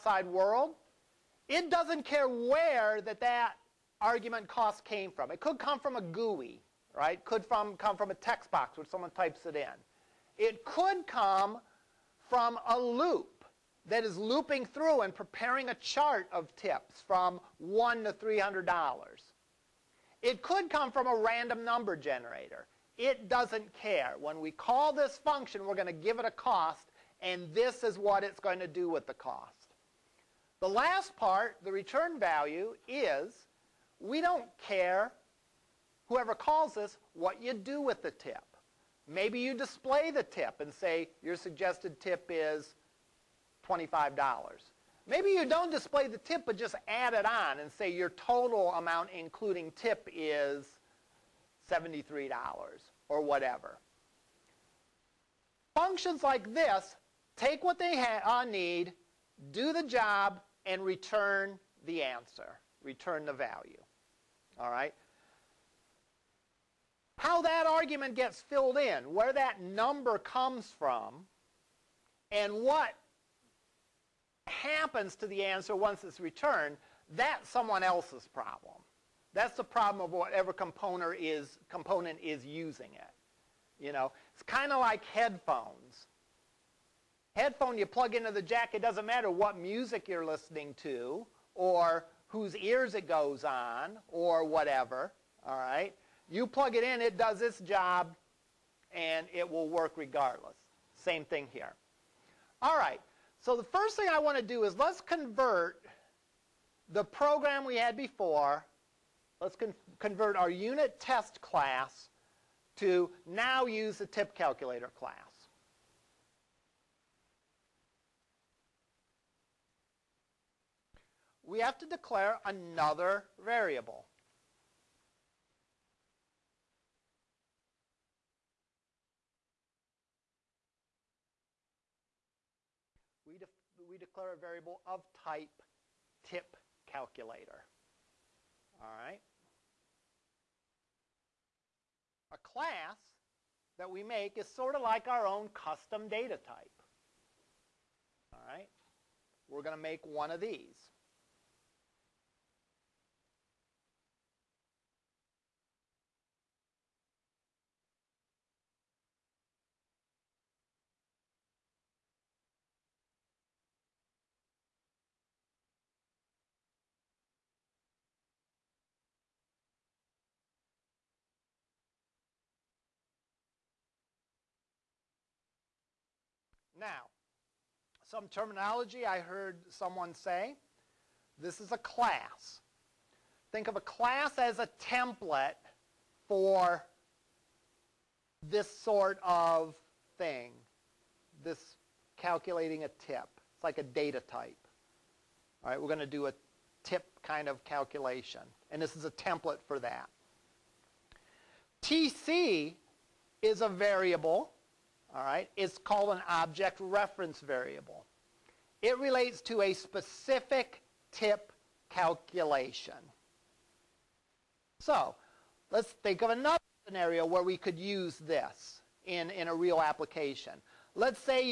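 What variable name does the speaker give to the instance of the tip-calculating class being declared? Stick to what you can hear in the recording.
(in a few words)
TC.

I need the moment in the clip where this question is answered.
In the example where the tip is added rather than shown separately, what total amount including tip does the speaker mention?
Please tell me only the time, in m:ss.
0:51.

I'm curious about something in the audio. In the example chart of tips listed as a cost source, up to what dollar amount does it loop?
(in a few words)
$300.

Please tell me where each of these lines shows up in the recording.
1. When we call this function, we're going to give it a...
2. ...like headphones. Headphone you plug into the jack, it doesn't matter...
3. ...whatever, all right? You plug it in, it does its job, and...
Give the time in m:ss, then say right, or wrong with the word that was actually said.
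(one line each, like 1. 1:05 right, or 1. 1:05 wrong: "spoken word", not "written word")
1. 0:24 right
2. 1:24 right
3. 1:34 right.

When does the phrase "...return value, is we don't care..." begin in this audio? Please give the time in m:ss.
0:31.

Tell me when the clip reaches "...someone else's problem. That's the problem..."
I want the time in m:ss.
1:17.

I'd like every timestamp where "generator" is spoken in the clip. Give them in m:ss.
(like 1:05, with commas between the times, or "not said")
0:21.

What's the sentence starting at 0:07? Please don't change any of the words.
Could from, come from a text box where someone types it in.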